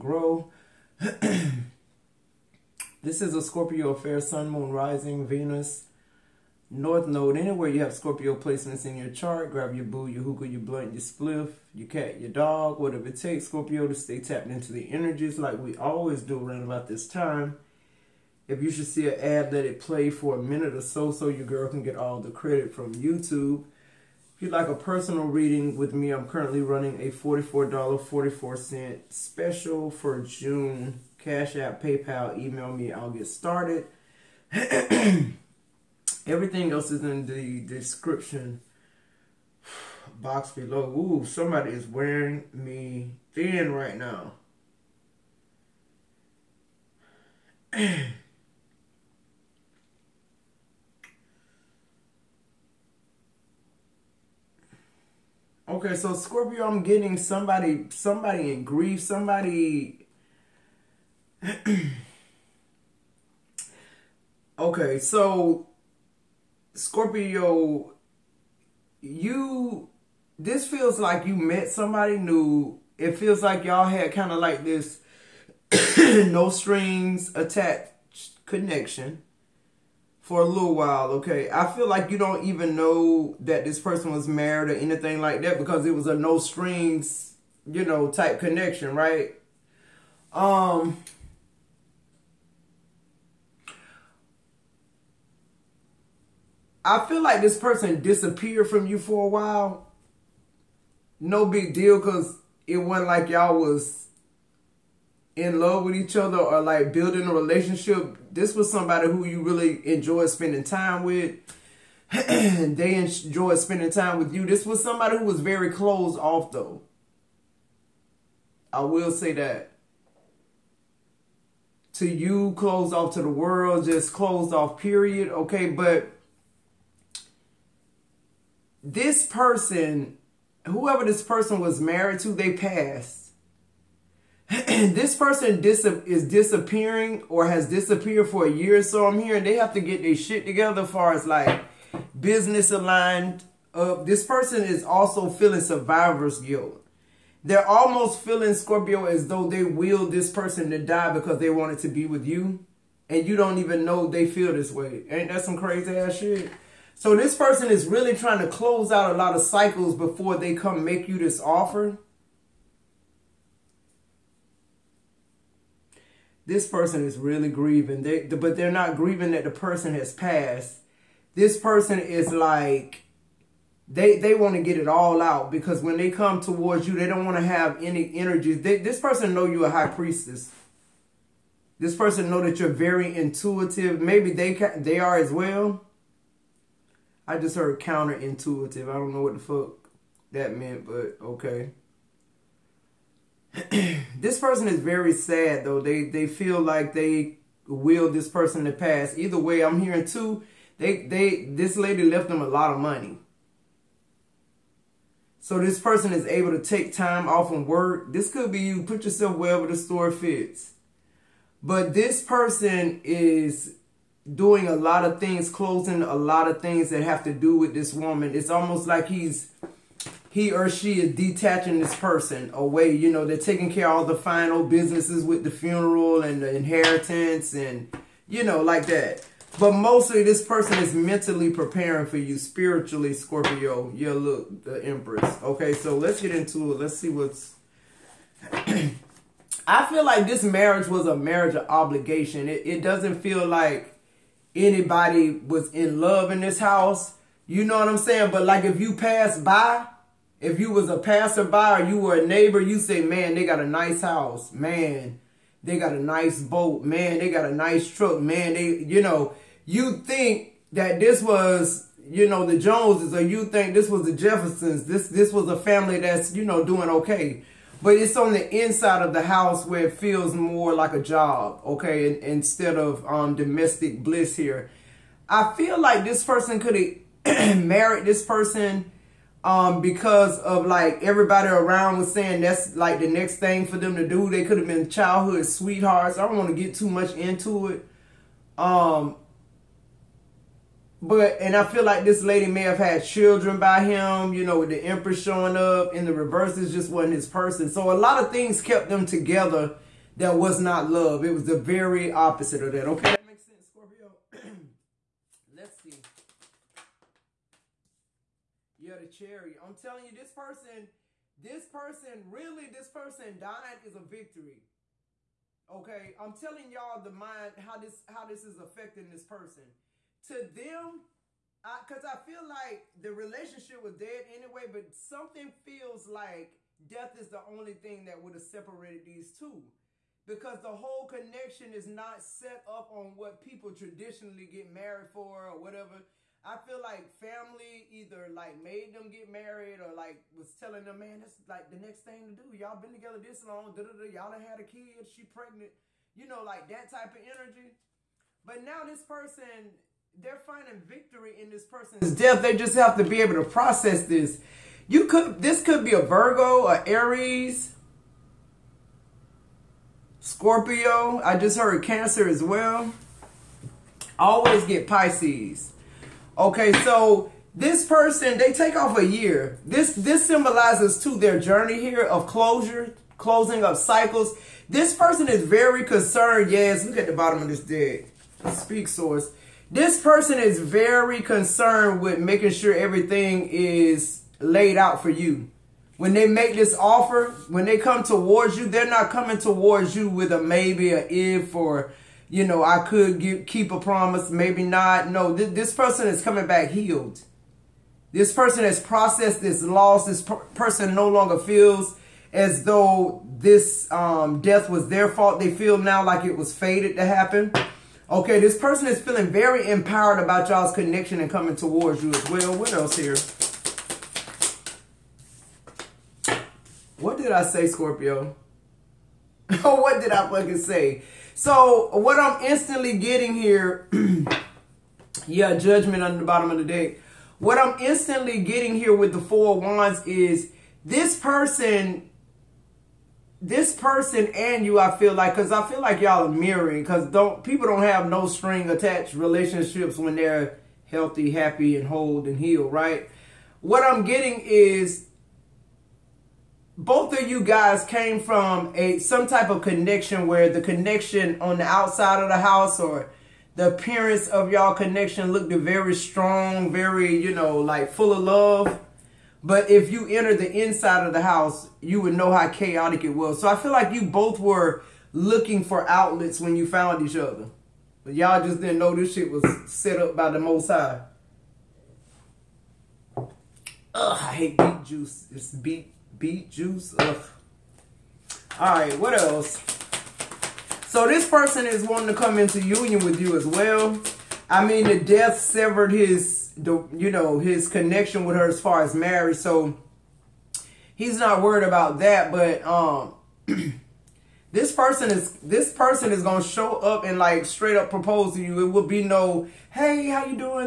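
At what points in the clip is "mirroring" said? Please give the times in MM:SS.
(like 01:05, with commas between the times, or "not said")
07:16.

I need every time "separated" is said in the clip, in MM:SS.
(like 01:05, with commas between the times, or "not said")
05:28.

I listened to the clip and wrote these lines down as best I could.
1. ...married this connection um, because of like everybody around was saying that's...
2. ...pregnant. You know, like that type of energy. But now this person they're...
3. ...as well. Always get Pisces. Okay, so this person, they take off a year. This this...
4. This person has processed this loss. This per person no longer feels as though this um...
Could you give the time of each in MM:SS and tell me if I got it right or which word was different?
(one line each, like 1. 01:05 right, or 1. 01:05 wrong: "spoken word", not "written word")
1. 04:37 wrong: "person", not "connection"
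2. 05:45 right
3. 06:02 right
4. 06:38 right.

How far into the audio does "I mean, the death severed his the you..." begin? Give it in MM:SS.
08:04.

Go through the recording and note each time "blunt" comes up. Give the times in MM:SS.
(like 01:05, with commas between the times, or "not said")
00:10.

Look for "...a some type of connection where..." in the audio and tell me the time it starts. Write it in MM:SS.
07:28.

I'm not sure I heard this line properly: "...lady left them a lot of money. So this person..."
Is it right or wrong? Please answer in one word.
right.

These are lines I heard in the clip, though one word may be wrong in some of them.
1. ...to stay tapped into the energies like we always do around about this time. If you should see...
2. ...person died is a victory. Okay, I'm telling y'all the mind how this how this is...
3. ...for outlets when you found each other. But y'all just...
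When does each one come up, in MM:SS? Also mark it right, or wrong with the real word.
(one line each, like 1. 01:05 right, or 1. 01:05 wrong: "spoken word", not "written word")
1. 00:13 right
2. 05:12 right
3. 07:45 right.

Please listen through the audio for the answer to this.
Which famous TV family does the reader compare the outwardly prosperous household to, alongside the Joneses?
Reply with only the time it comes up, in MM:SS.
04:24.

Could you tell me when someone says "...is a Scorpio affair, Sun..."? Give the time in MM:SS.
00:03.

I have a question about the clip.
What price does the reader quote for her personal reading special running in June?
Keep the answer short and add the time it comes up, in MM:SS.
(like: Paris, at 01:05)
$44.44, at 00:27.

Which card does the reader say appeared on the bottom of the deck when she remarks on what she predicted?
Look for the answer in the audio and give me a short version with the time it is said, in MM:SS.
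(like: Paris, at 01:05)
Judgment, at 07:05.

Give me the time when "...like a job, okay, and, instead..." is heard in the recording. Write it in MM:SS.
04:30.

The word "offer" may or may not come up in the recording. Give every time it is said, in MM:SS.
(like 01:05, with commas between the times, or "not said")
02:41, 06:26.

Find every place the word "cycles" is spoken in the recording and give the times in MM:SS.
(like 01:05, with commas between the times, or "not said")
02:39, 06:13.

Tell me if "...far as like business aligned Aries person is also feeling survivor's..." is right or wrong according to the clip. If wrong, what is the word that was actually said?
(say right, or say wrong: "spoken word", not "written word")
wrong: "This", not "Aries".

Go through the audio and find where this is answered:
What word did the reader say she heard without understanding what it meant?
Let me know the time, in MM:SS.
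03:07.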